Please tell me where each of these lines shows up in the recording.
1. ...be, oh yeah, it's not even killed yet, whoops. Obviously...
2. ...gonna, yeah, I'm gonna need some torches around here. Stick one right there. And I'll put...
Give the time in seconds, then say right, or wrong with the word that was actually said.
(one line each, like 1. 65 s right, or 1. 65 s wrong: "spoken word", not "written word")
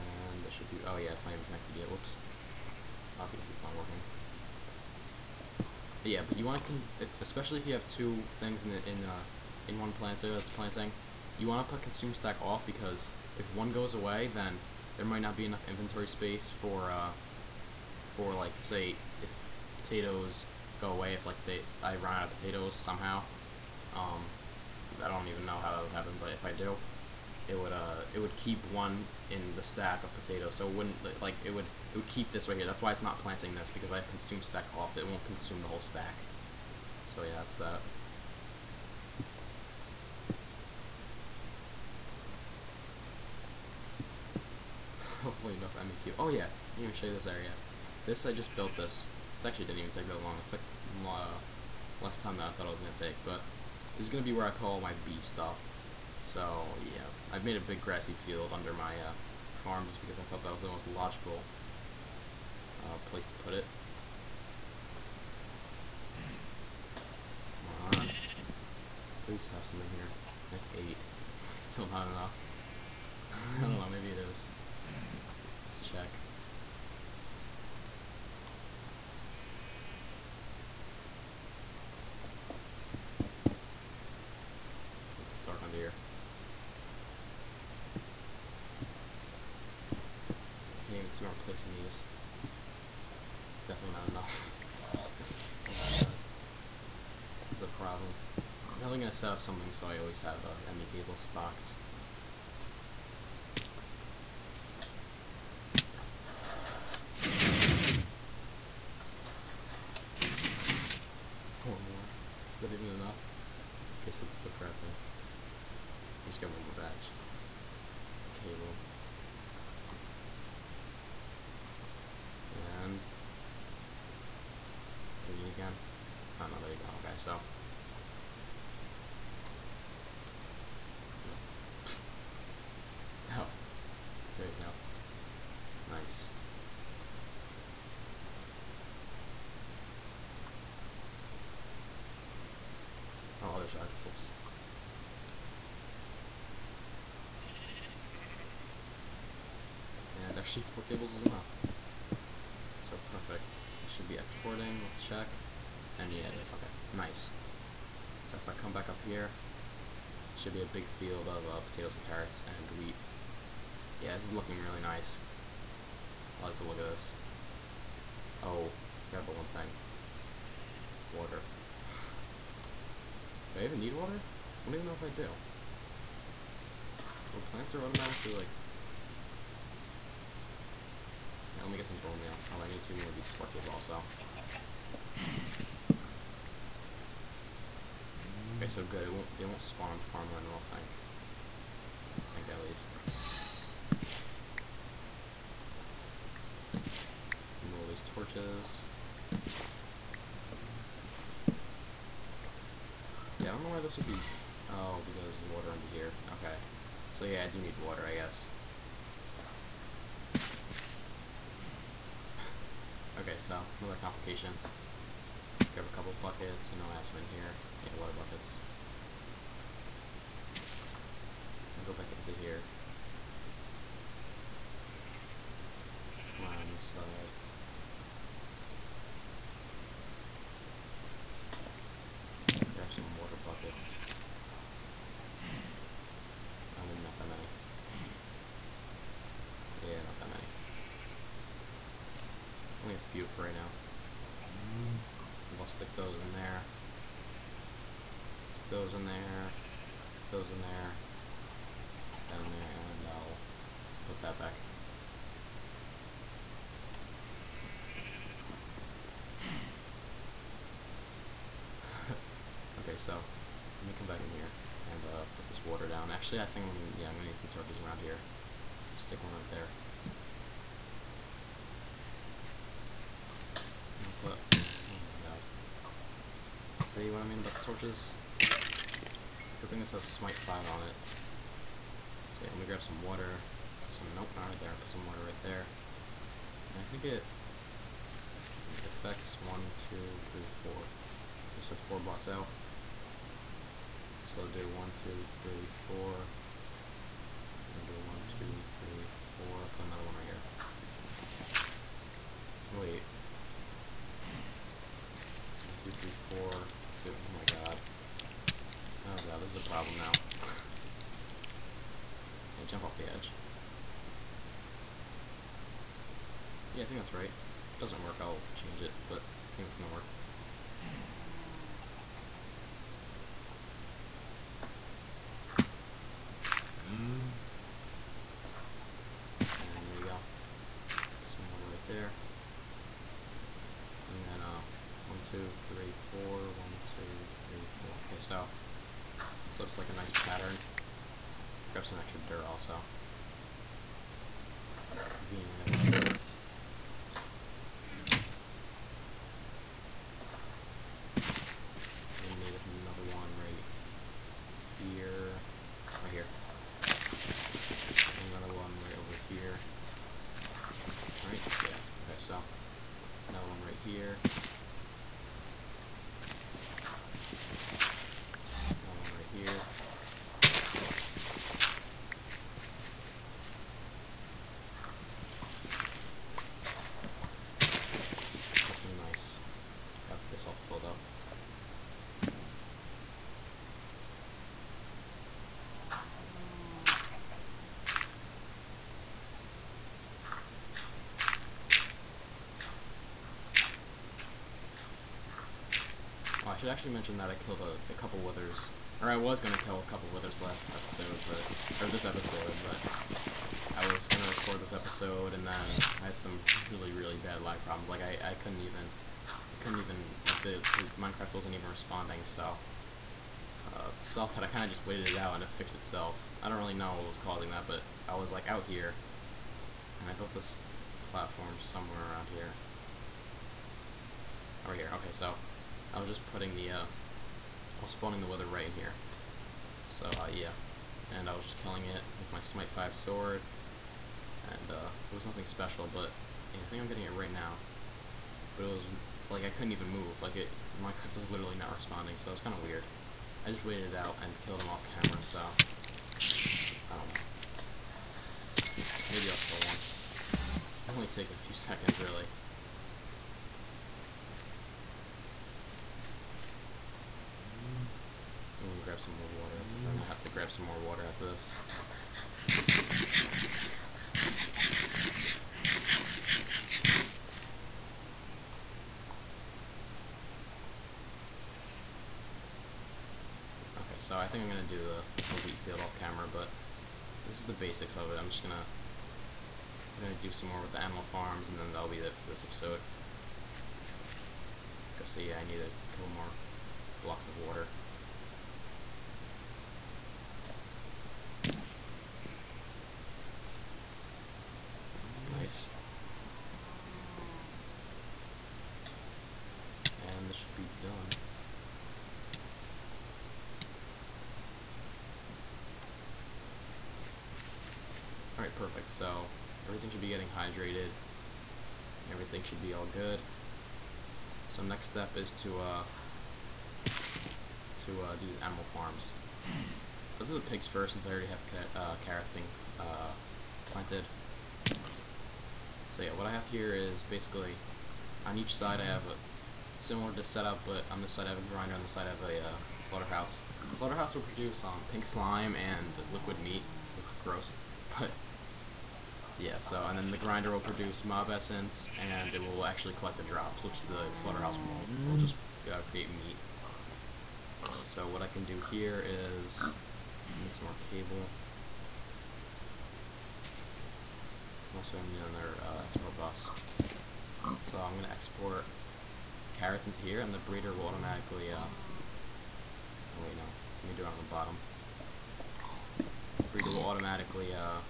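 1. 0 s wrong: "connected", not "killed"
2. 266 s right.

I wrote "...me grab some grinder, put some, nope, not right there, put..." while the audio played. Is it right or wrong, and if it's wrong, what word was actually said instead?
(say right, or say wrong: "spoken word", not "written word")
wrong: "water", not "grinder".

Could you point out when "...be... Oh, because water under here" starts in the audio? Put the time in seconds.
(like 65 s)
204 s.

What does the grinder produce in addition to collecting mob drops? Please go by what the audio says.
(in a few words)
Mob essence.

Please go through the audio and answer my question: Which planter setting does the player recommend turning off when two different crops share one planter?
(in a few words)
Consume stack.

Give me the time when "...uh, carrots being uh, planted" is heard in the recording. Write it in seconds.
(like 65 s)
521 s.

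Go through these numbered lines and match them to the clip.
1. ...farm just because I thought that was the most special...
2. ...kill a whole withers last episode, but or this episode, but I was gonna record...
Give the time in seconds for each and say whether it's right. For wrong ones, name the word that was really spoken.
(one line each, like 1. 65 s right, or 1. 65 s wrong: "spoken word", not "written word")
1. 59 s wrong: "logical", not "special"
2. 399 s wrong: "couple", not "whole".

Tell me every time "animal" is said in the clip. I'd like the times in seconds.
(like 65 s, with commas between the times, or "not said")
480 s, 518 s.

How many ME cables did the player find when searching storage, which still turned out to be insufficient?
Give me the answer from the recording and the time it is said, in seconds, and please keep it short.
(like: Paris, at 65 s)
8, at 70 s.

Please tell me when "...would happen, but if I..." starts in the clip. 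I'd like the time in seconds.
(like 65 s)
25 s.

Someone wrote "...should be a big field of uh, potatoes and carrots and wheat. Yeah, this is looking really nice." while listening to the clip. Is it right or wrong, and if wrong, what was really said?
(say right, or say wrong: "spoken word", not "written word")
right.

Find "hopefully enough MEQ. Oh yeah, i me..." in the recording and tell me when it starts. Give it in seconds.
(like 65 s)
45 s.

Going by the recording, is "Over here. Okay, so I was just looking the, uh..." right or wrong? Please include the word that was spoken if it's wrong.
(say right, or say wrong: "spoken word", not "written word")
wrong: "putting", not "looking".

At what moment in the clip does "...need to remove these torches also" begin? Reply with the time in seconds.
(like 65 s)
182 s.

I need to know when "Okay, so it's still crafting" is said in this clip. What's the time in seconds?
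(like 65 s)
114 s.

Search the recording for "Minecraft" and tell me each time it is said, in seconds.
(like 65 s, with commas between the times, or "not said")
410 s, 440 s.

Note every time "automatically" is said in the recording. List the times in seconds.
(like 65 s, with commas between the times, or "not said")
177 s, 560 s, 566 s.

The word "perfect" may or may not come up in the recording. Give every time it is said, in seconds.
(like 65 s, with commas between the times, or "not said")
152 s, 508 s.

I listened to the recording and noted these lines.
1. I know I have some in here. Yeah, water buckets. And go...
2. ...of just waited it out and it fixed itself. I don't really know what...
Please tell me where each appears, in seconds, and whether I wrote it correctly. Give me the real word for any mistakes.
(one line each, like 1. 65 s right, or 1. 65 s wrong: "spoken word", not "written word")
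1. 216 s right
2. 414 s right.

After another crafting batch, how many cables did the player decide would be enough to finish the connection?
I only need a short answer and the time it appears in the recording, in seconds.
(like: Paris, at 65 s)
4, at 150 s.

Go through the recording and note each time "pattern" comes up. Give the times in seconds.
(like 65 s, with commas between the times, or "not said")
340 s.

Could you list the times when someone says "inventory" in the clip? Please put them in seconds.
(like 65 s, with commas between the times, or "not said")
15 s.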